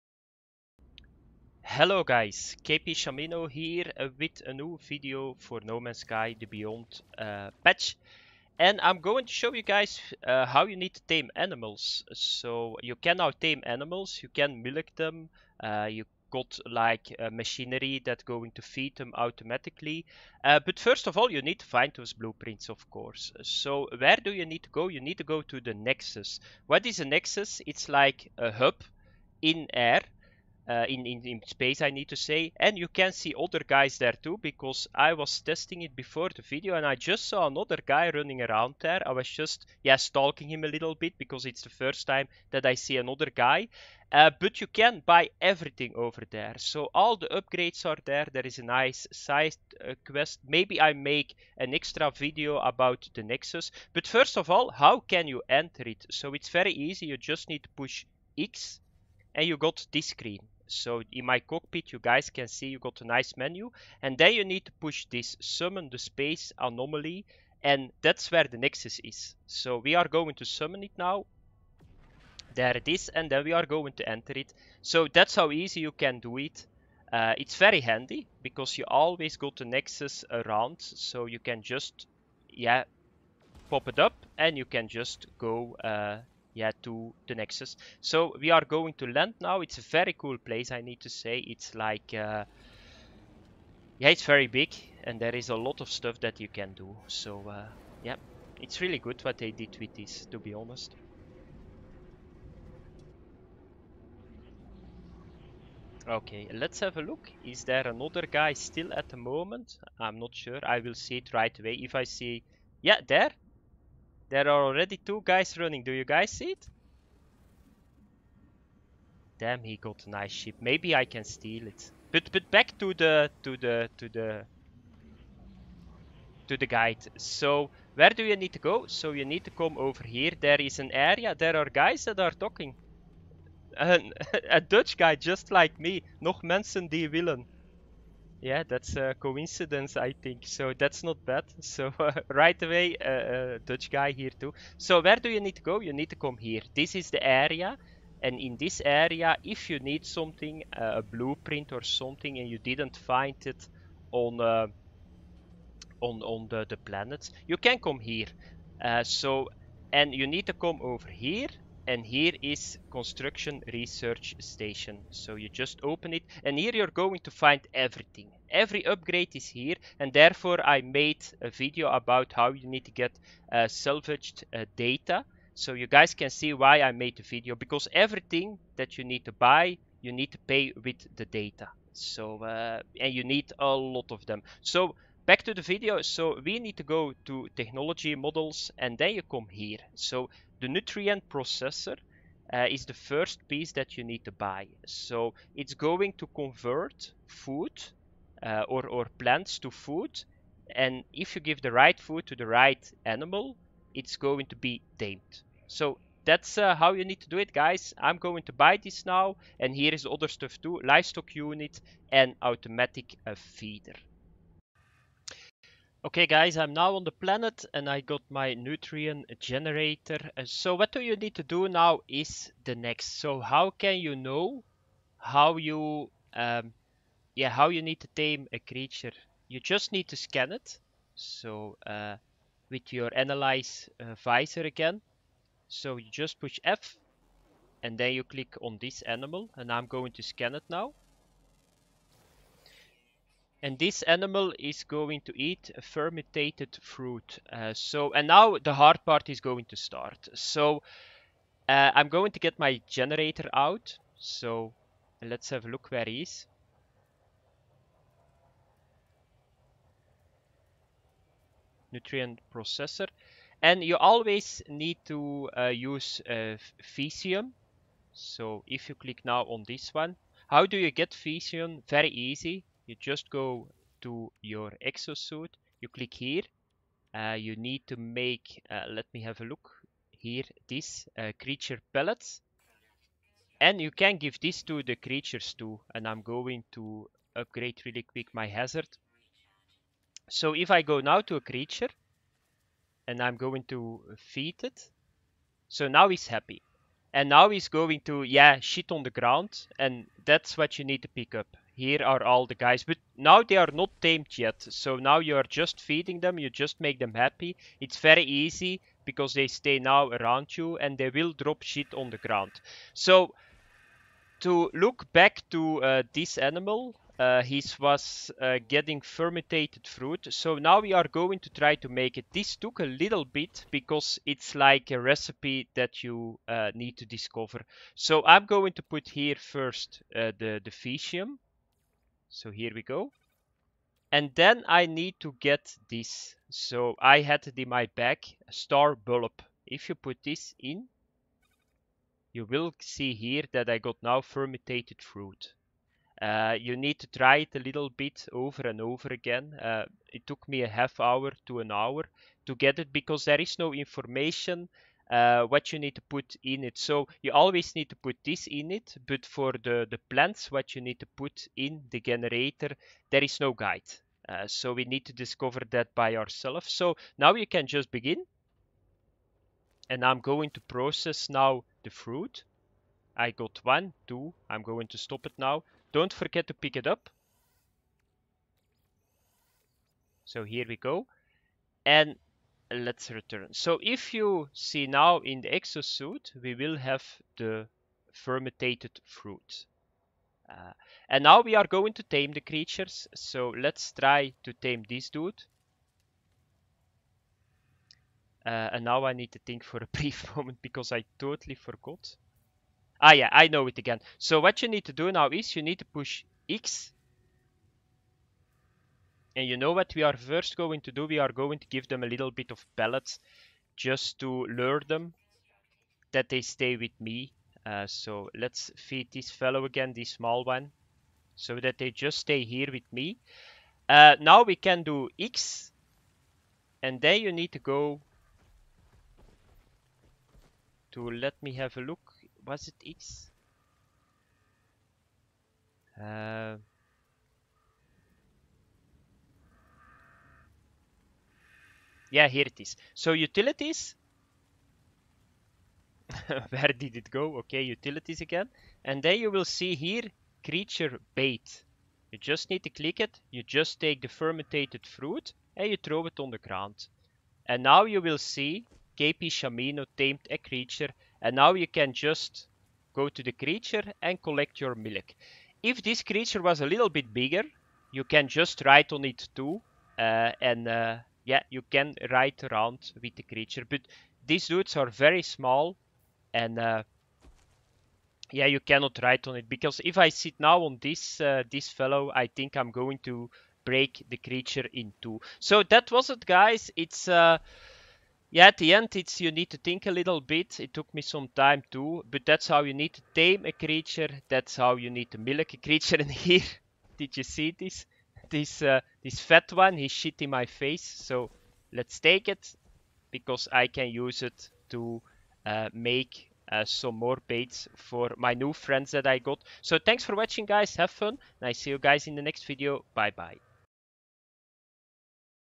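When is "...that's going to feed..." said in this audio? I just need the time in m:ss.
0:18.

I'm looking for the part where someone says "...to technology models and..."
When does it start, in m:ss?
3:07.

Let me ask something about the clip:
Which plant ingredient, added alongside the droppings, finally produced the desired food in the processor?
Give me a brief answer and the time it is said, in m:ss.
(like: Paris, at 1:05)
Star bulb, at 5:38.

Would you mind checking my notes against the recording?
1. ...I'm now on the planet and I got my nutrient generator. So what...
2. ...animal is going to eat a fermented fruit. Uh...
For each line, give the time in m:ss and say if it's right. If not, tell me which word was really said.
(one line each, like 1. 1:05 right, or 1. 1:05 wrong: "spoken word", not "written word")
1. 3:36 right
2. 4:04 right.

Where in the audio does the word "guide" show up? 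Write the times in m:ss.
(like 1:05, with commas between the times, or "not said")
2:06, 6:03.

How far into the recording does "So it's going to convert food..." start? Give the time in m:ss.
3:14.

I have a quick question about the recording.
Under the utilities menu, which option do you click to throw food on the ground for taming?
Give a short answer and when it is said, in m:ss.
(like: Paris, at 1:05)
Creature bait, at 7:30.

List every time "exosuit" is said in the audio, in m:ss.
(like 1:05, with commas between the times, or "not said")
4:34, 6:25.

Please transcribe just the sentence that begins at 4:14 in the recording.
So, let's have a look where he is.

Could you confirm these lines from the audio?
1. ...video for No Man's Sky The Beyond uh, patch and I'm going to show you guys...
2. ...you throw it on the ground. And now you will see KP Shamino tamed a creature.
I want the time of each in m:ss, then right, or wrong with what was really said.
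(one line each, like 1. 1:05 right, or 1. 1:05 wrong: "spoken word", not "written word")
1. 0:04 right
2. 7:35 right.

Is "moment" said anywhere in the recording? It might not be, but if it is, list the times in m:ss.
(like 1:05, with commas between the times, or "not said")
1:49, 6:40.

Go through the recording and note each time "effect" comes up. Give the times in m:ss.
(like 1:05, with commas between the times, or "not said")
not said.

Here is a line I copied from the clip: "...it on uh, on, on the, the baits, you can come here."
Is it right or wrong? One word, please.
wrong.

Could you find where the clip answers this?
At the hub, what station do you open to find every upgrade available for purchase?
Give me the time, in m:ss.
2:42.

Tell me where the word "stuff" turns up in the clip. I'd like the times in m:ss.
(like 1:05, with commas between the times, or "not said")
1:35, 3:30.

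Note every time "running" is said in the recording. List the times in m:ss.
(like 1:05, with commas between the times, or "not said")
0:38, 1:55.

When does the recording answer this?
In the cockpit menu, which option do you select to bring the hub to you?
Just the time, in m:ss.
1:05.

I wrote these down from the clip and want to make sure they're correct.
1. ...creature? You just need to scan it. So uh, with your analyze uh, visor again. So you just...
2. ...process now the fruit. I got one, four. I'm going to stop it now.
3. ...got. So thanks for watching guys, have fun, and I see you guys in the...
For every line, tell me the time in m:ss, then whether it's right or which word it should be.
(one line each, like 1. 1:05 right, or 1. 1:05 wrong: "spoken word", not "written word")
1. 3:48 right
2. 6:10 wrong: "two", not "four"
3. 8:29 right.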